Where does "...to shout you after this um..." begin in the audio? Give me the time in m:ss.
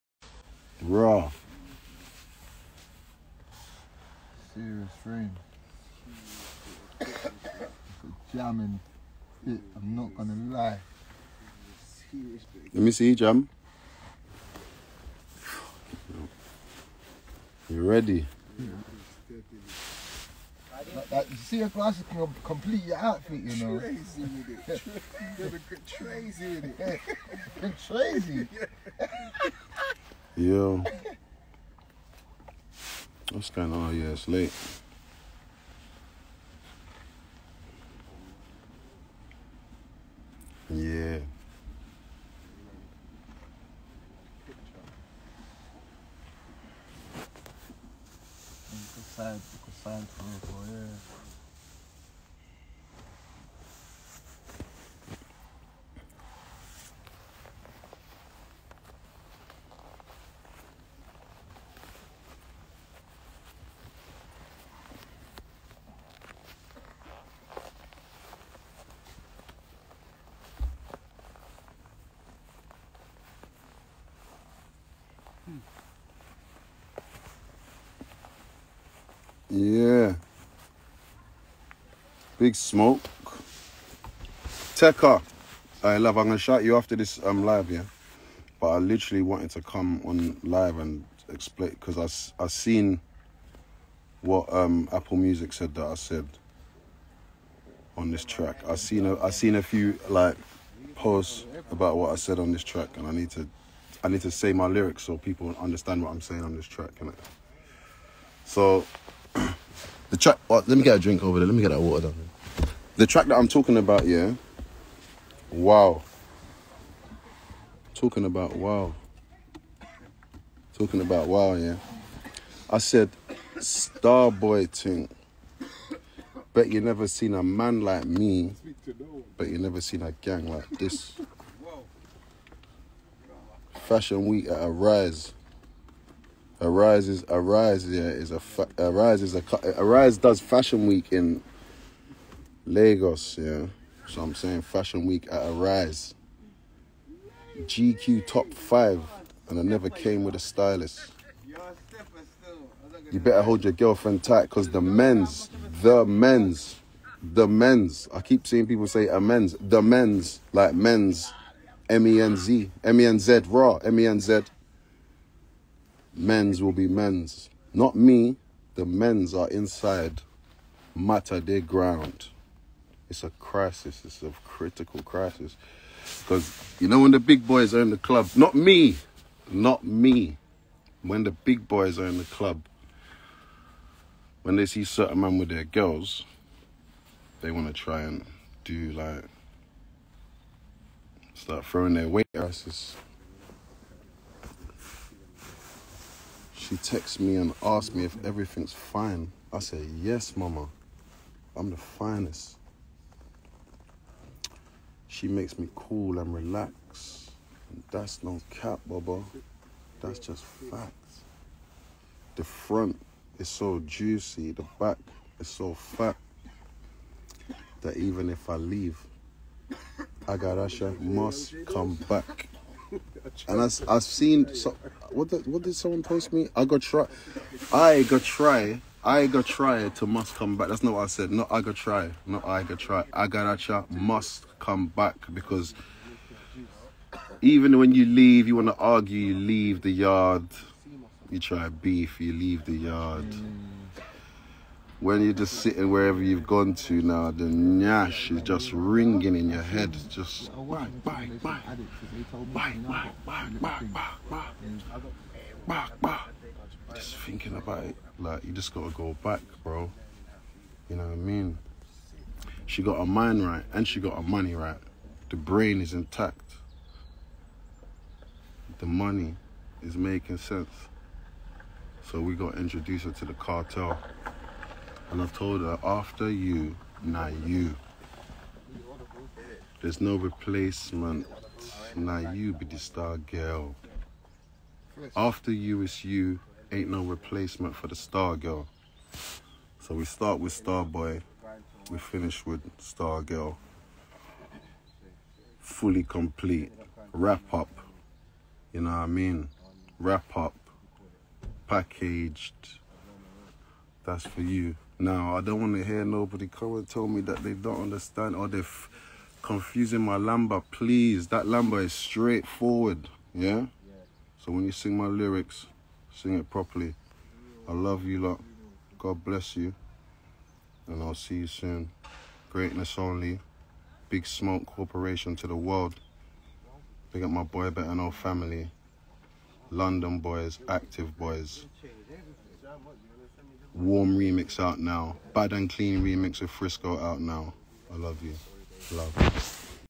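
1:26.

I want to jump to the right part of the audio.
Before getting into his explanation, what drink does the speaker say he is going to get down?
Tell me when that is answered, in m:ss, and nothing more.
1:51.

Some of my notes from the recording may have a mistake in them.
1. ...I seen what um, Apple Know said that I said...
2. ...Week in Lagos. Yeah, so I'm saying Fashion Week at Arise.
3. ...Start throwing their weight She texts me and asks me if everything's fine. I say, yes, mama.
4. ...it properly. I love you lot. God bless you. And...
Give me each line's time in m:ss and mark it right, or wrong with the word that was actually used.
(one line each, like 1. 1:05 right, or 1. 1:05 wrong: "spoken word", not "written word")
1. 1:32 wrong: "Music", not "Know"
2. 2:20 right
3. 3:11 right
4. 5:16 right.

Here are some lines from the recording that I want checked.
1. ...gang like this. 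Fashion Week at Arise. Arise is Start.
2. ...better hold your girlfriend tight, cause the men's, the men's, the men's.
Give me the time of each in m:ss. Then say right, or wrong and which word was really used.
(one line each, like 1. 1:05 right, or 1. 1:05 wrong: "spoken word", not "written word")
1. 2:10 wrong: "Arise", not "Start"
2. 2:33 right.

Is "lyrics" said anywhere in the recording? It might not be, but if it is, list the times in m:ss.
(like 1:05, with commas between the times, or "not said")
1:44, 5:15.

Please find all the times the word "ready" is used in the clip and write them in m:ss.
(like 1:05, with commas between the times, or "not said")
0:17.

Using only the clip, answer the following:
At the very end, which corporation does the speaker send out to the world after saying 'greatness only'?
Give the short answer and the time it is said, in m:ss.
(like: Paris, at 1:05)
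Big Smoke Corporation, at 5:24.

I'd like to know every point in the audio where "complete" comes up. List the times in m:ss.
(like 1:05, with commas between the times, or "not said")
0:22, 4:56.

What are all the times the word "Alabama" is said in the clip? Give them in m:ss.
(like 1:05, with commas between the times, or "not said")
not said.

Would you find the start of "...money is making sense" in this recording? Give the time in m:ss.
4:28.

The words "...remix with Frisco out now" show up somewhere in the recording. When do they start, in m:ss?
5:36.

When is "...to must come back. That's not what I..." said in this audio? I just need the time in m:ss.
3:49.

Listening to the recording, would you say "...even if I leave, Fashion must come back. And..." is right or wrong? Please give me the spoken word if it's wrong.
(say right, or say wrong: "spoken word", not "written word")
wrong: "Agarasha", not "Fashion".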